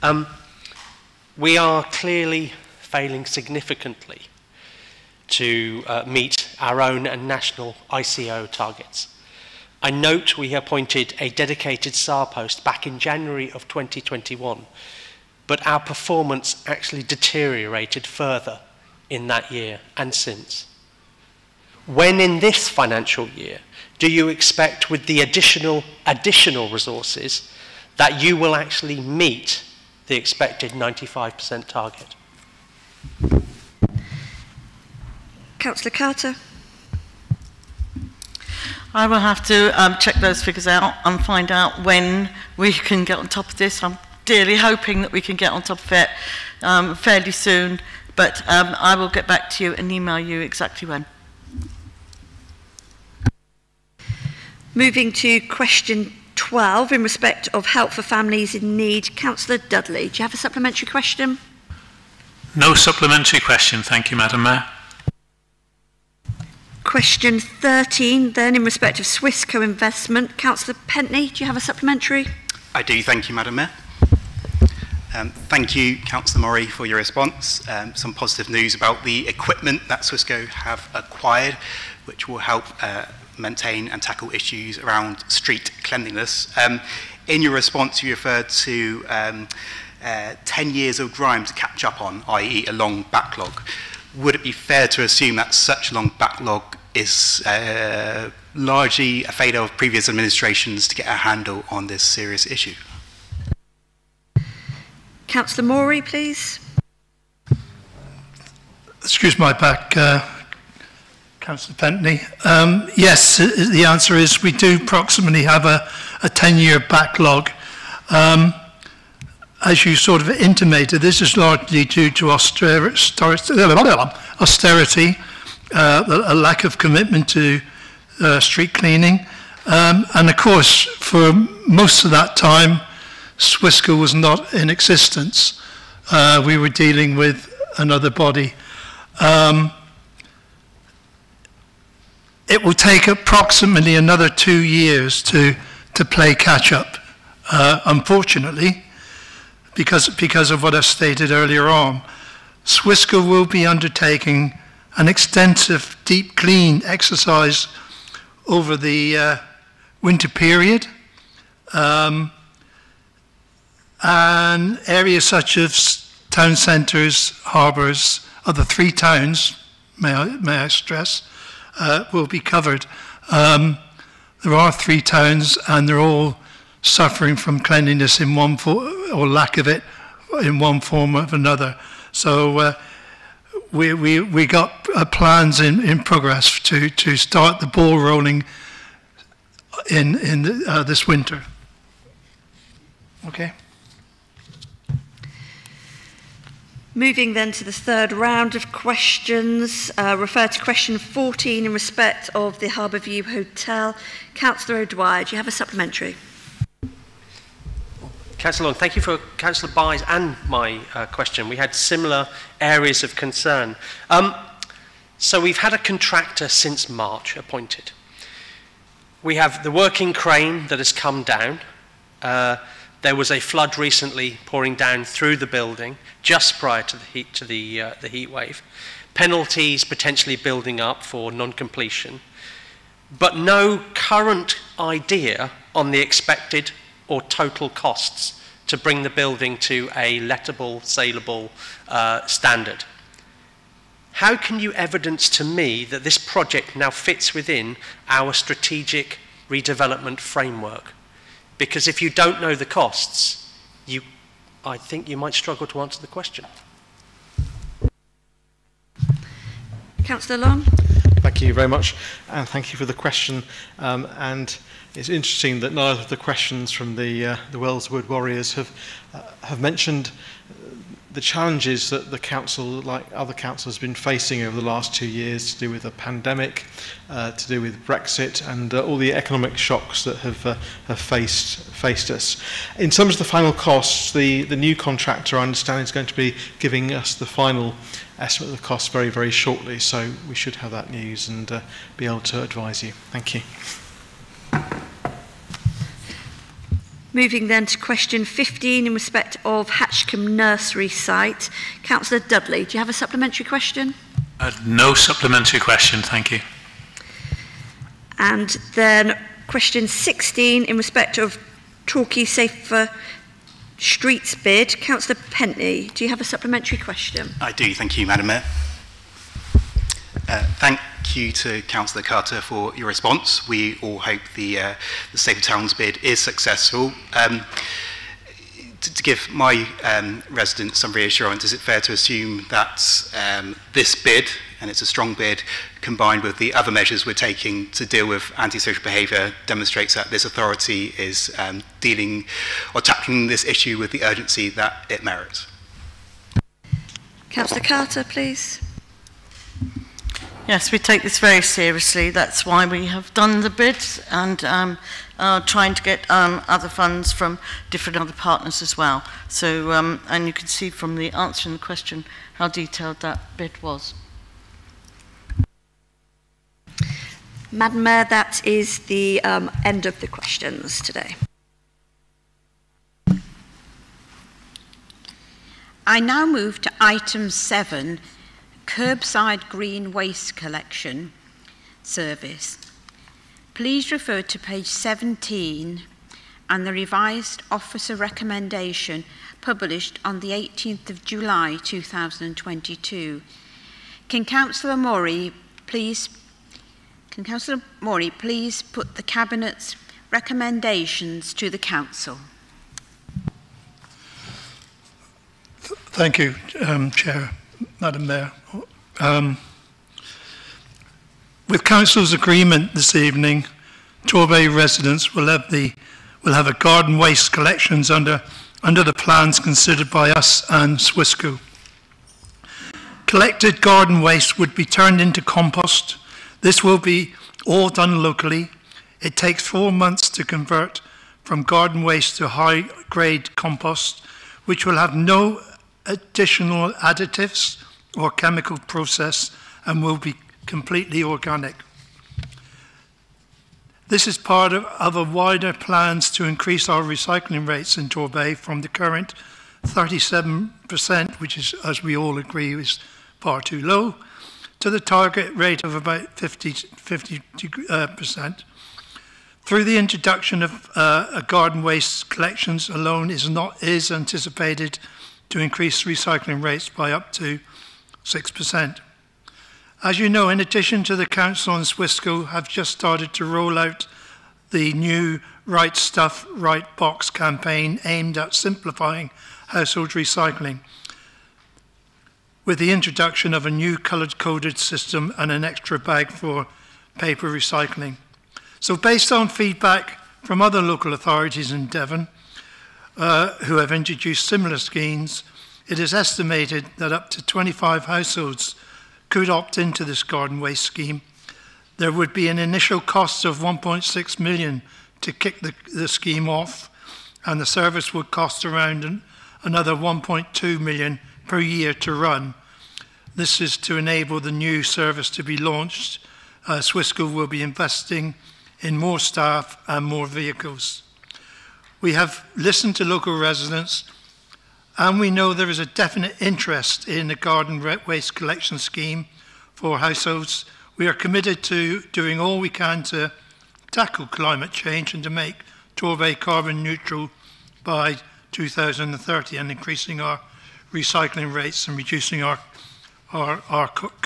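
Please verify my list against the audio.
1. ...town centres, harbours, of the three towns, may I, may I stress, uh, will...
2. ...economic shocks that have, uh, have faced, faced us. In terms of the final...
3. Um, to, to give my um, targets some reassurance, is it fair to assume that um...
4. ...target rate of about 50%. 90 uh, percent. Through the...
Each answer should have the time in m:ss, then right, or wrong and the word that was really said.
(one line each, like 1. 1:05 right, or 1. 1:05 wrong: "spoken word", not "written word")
1. 2:46 right
2. 4:39 right
3. 5:27 wrong: "residents", not "targets"
4. 7:34 wrong: "50", not "90".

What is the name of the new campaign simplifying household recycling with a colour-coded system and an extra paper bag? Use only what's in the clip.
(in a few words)
Right Stuff, Right Box.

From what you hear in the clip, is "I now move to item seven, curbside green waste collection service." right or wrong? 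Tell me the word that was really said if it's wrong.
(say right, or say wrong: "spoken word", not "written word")
right.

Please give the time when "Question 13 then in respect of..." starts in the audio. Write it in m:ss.
1:06.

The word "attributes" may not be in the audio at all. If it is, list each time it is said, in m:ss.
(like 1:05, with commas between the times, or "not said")
not said.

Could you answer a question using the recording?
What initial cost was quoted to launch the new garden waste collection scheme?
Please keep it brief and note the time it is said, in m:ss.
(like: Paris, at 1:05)
1.6 million, at 8:23.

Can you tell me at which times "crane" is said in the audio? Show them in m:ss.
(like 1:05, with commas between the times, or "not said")
3:40.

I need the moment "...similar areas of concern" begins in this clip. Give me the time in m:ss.
3:31.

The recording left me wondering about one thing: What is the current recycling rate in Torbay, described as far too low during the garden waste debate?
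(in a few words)
37%.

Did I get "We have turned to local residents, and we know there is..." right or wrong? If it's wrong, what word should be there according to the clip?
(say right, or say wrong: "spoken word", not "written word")
wrong: "listened", not "turned".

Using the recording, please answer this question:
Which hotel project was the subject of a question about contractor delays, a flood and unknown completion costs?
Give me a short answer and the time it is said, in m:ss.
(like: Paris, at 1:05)
Harbour View Hotel, at 3:22.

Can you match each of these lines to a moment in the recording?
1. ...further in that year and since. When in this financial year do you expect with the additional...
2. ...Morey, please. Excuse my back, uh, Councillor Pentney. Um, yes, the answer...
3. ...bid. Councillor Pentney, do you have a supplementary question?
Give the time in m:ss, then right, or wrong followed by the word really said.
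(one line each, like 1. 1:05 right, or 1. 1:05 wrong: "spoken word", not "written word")
1. 0:18 right
2. 1:45 right
3. 5:14 right.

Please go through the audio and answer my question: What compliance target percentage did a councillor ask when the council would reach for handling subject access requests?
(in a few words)
95%.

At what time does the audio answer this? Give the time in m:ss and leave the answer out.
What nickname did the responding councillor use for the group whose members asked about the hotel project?
4:27.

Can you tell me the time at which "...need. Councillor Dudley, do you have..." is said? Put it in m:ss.
0:58.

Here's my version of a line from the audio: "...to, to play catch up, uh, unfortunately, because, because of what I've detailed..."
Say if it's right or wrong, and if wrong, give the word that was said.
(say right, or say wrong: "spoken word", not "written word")
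wrong: "stated", not "detailed".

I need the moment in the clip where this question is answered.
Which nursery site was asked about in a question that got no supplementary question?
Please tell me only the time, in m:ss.
4:59.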